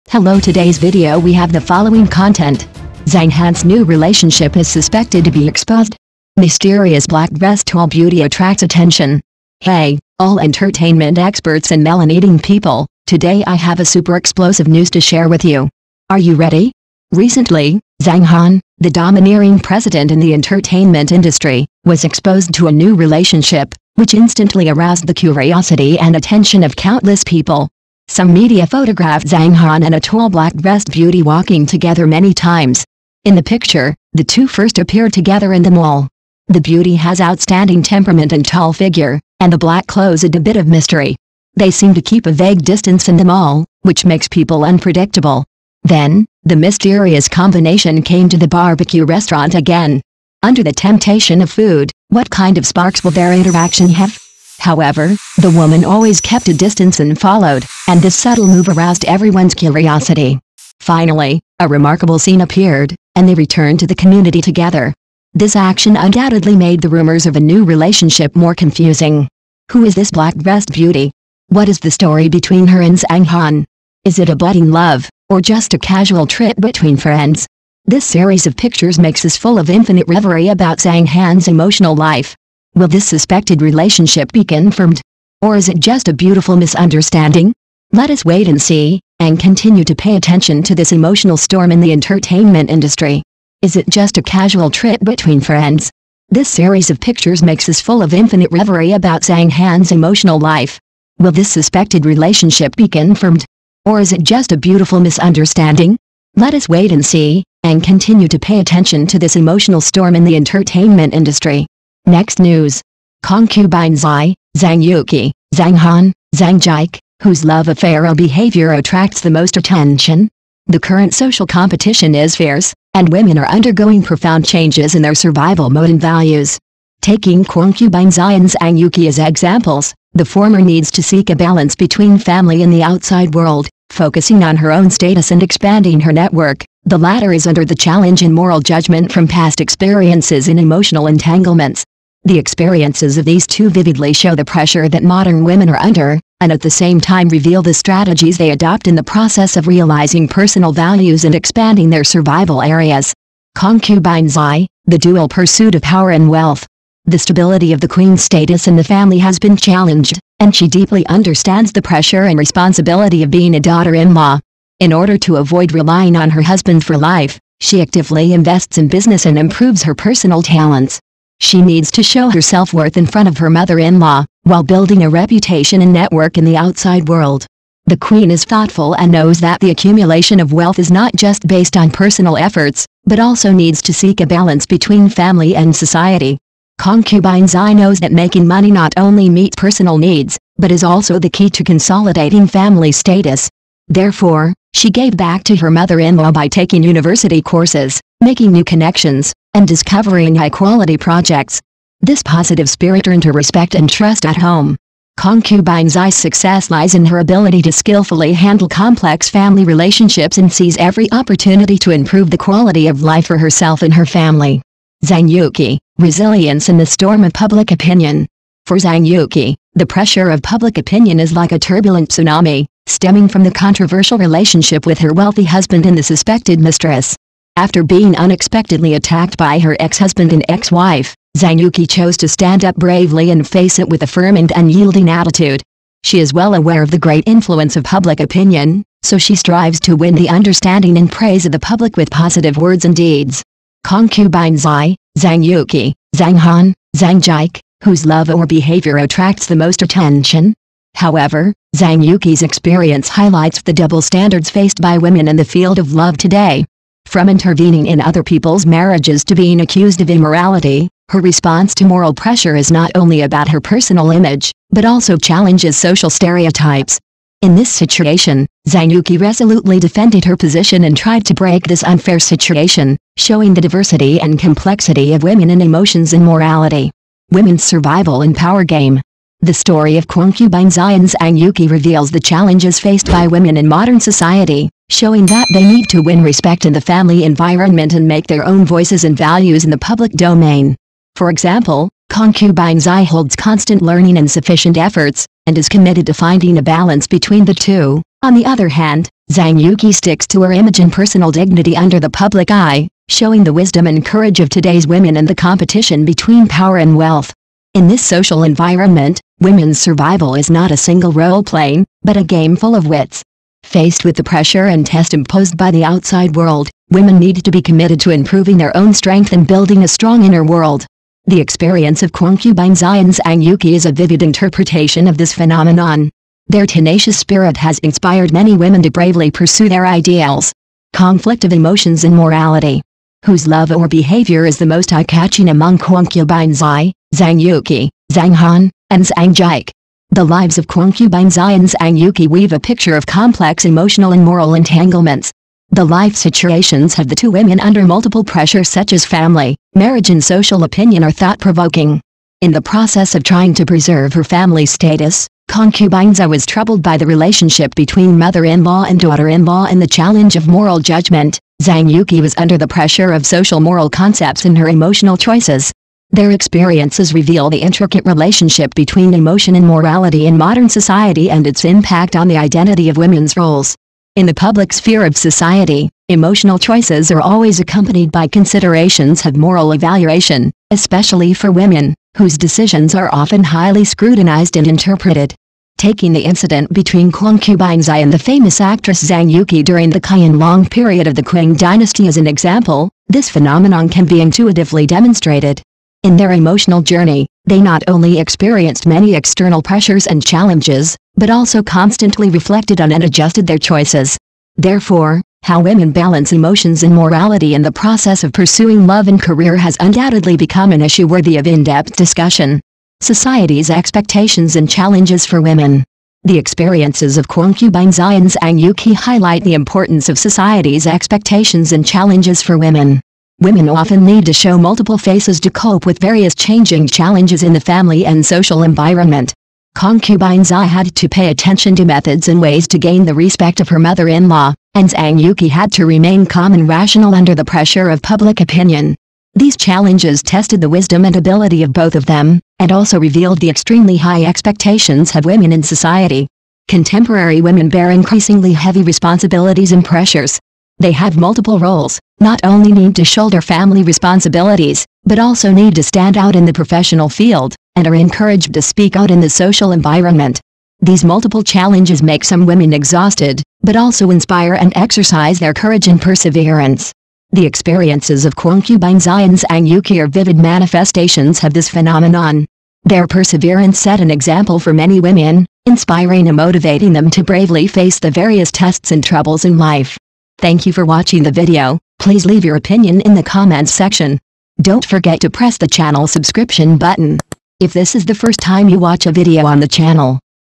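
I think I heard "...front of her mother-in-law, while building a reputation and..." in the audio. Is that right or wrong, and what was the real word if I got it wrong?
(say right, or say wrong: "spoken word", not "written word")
right.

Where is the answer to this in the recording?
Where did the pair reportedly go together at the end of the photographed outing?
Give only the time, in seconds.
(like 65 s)
63 s.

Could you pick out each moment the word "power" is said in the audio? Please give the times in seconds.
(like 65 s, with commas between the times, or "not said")
155 s, 278 s, 306 s.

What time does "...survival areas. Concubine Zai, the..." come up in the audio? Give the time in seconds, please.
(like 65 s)
152 s.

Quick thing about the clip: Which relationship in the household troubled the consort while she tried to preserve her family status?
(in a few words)
Mother-in-law and daughter-in-law.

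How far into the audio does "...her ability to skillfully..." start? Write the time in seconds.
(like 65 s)
207 s.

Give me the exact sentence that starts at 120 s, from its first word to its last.
The current social competition is fierce, and women are undergoing profound changes in their survival mode and values.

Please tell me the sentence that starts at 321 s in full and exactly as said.
The experience of concubine Zion's Angyuki is a vivid interpretation of this phenomenon.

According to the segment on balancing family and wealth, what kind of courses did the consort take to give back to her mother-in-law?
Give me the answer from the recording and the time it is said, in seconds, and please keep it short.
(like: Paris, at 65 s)
University courses, at 196 s.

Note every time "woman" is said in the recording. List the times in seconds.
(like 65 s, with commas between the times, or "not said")
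55 s.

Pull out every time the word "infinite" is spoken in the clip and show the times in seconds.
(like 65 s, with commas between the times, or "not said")
79 s, 98 s.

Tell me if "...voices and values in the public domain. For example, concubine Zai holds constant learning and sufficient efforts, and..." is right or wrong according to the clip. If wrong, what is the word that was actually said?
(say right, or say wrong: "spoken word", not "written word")
right.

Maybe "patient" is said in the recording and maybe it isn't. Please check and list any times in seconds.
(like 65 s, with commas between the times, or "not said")
not said.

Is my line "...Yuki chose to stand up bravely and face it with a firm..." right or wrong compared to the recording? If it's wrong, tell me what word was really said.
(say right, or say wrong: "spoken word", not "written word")
right.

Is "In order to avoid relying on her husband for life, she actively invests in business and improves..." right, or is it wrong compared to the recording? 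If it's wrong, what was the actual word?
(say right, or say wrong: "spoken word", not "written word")
right.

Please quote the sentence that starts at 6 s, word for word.
Mysterious black dress tall beauty attracts attention.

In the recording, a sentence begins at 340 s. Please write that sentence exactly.
The lives of concubines Ions and Yuki weave a picture of complex emotional and moral entanglements.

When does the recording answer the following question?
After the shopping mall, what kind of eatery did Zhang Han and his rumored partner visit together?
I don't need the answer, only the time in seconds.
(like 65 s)
48 s.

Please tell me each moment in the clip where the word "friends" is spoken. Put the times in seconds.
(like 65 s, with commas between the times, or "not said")
76 s, 95 s.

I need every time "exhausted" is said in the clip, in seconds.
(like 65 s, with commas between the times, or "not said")
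462 s.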